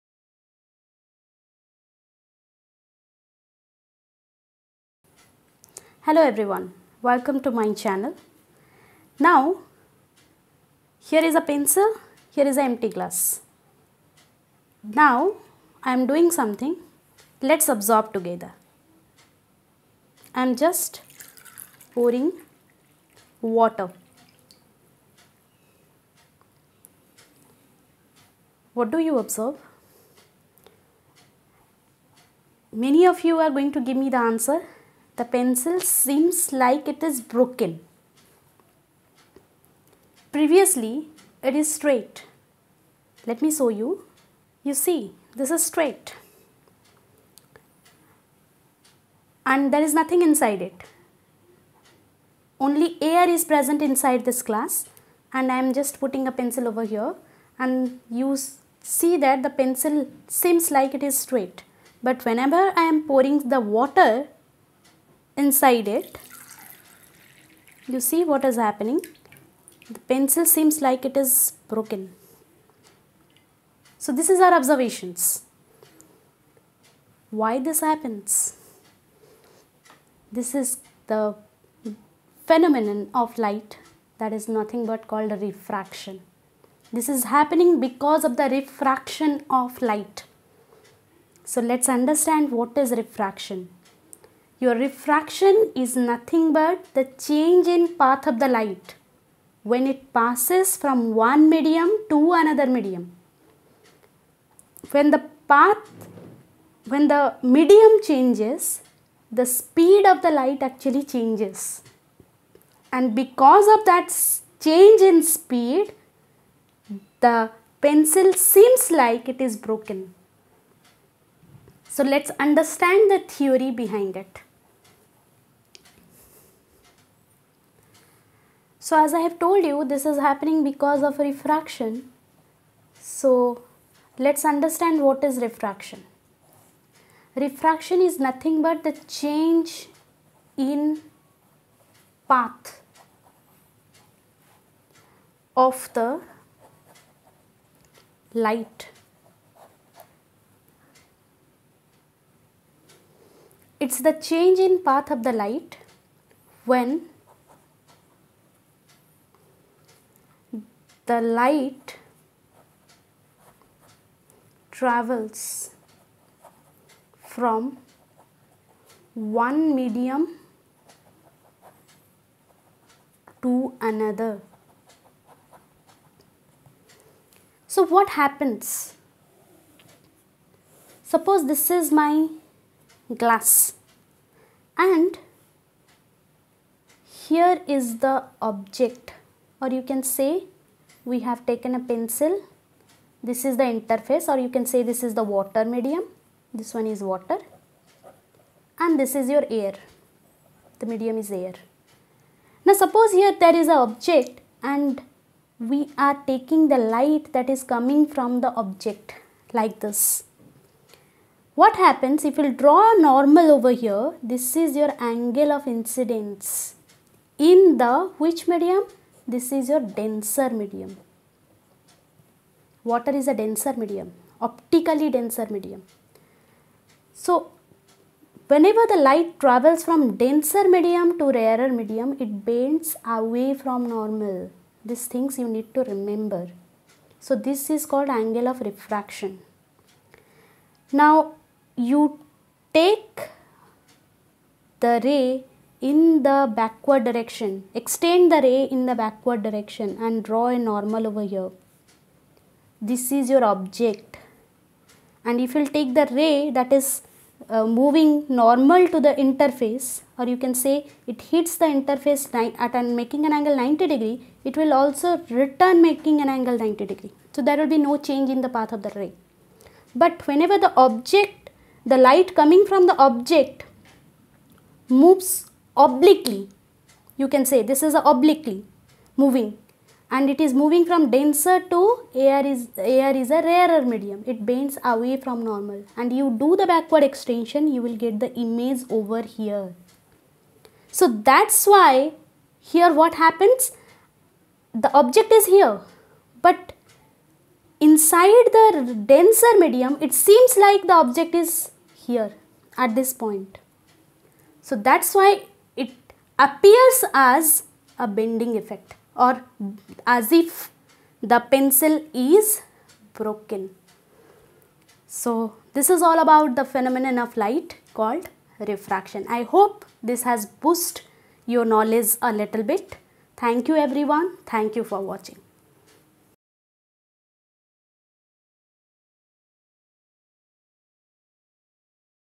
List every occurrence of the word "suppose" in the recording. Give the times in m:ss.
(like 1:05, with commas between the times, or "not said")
3:01, 3:22.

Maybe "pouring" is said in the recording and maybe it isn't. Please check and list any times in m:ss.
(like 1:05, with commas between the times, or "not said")
0:21, 1:03.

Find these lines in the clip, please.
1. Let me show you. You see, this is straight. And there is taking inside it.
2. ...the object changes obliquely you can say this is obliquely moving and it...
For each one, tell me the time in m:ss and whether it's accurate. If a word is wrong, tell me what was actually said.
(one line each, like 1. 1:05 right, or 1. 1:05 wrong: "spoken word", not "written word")
1. 0:43 wrong: "nothing", not "taking"
2. 4:32 wrong: "moves", not "changes".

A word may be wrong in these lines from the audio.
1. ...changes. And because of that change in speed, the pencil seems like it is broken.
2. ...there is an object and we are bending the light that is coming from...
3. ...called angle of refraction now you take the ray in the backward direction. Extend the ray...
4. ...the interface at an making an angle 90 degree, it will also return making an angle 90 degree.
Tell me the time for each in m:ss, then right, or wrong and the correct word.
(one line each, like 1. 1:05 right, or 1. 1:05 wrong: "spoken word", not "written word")
1. 1:51 right
2. 3:23 wrong: "taking", not "bending"
3. 3:57 right
4. 4:21 right.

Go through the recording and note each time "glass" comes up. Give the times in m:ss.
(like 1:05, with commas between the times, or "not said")
0:12, 0:54, 3:03.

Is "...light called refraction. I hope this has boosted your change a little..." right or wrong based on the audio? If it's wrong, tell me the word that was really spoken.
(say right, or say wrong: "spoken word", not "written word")
wrong: "knowledge", not "change".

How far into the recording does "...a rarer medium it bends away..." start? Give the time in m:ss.
4:43.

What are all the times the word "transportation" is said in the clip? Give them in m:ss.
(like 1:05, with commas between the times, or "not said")
not said.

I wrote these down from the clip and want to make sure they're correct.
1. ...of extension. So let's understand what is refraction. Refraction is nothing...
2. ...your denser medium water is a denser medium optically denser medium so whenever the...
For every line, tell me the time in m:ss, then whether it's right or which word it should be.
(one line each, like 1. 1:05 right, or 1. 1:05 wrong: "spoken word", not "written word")
1. 2:11 wrong: "refraction", not "extension"
2. 3:39 right.